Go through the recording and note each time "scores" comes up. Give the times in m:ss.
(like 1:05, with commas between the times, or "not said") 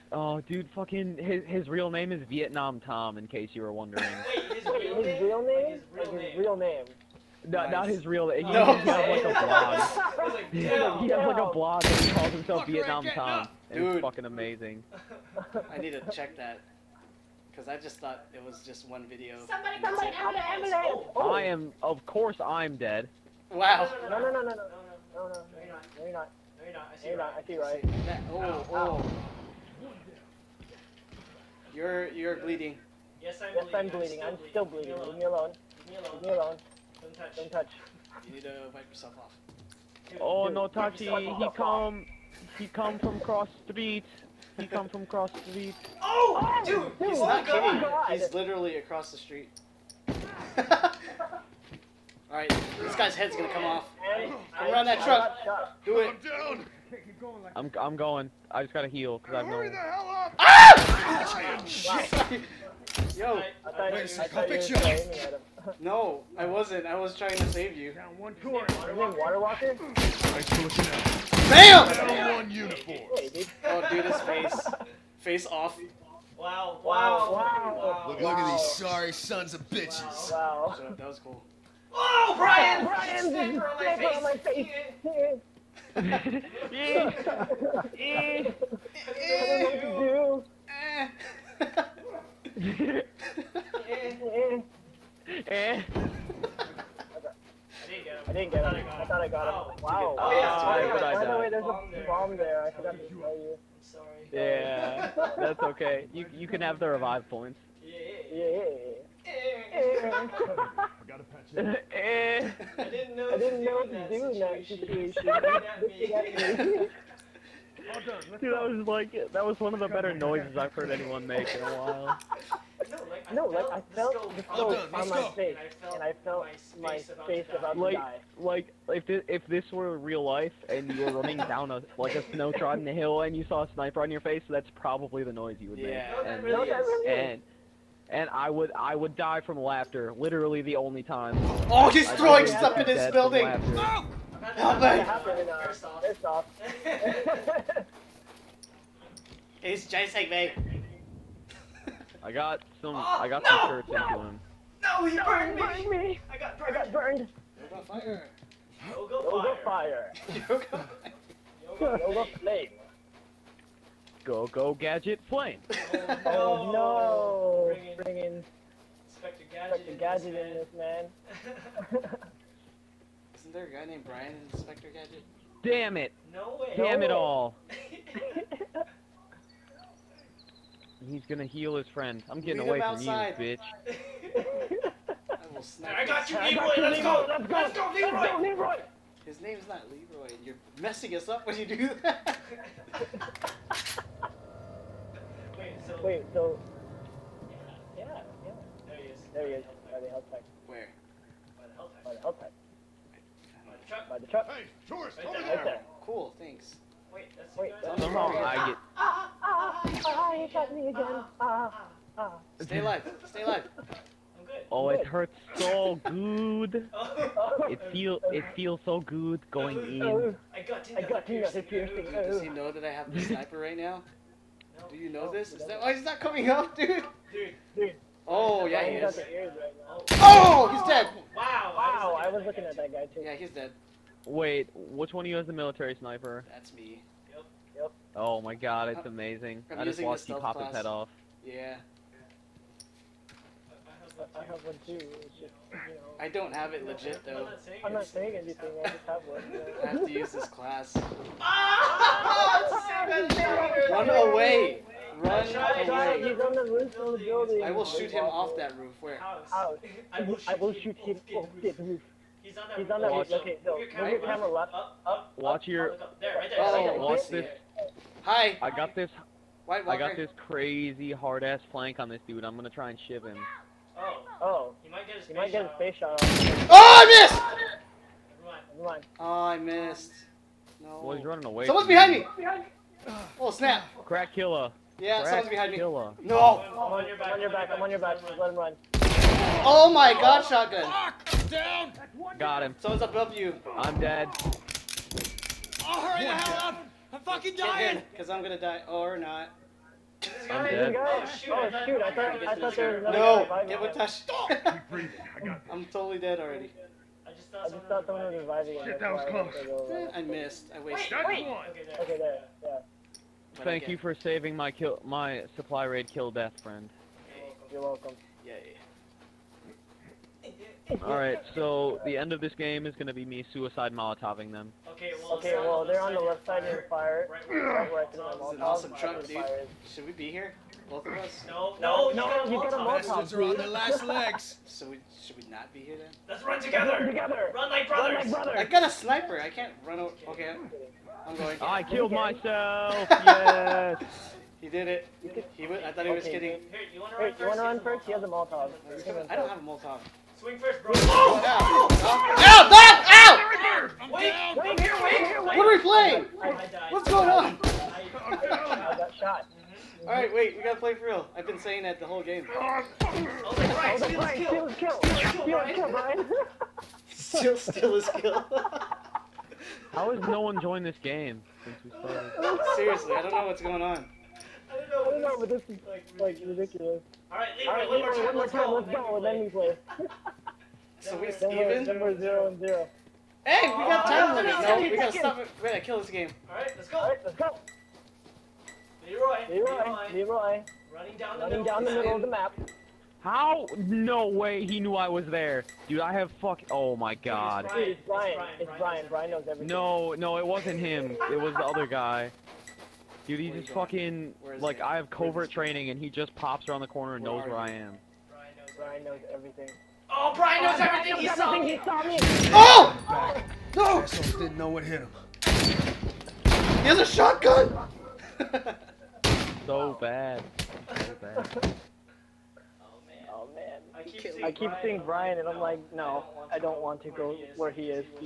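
not said.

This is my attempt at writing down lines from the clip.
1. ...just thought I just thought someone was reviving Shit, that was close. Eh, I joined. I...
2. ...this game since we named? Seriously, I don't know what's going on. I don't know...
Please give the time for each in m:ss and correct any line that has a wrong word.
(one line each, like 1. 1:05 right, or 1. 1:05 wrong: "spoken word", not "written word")
1. 5:07 wrong: "missed", not "joined"
2. 6:10 wrong: "started", not "named".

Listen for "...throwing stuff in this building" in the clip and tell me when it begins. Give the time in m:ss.
2:22.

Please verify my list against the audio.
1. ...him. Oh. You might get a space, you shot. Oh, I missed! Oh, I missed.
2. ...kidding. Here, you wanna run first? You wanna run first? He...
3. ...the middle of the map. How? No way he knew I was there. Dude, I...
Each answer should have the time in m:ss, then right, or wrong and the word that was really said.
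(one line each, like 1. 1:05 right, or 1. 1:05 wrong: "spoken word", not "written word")
1. 4:33 right
2. 5:46 right
3. 6:31 right.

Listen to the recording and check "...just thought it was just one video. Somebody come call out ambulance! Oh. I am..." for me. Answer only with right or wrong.
right.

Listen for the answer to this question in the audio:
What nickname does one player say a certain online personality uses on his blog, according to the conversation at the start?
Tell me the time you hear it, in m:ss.
0:02.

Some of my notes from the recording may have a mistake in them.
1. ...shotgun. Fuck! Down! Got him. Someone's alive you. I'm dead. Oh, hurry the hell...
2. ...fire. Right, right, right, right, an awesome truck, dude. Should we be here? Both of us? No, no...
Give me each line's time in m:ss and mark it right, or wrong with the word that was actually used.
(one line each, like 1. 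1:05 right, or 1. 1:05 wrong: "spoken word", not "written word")
1. 4:50 wrong: "above", not "alive"
2. 5:26 right.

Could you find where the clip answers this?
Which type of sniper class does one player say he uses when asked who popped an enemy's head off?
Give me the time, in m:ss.
3:55.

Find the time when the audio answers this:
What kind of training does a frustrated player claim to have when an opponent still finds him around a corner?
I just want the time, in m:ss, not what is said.
6:45.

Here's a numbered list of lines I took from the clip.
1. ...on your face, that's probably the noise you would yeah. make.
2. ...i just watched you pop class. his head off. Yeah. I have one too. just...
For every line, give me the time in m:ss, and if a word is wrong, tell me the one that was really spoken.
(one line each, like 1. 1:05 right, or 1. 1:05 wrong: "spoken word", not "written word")
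1. 2:14 right
2. 3:59 right.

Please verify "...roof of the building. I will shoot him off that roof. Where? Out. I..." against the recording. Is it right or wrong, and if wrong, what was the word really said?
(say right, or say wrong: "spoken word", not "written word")
right.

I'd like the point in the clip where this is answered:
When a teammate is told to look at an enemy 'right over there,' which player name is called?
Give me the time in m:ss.
3:24.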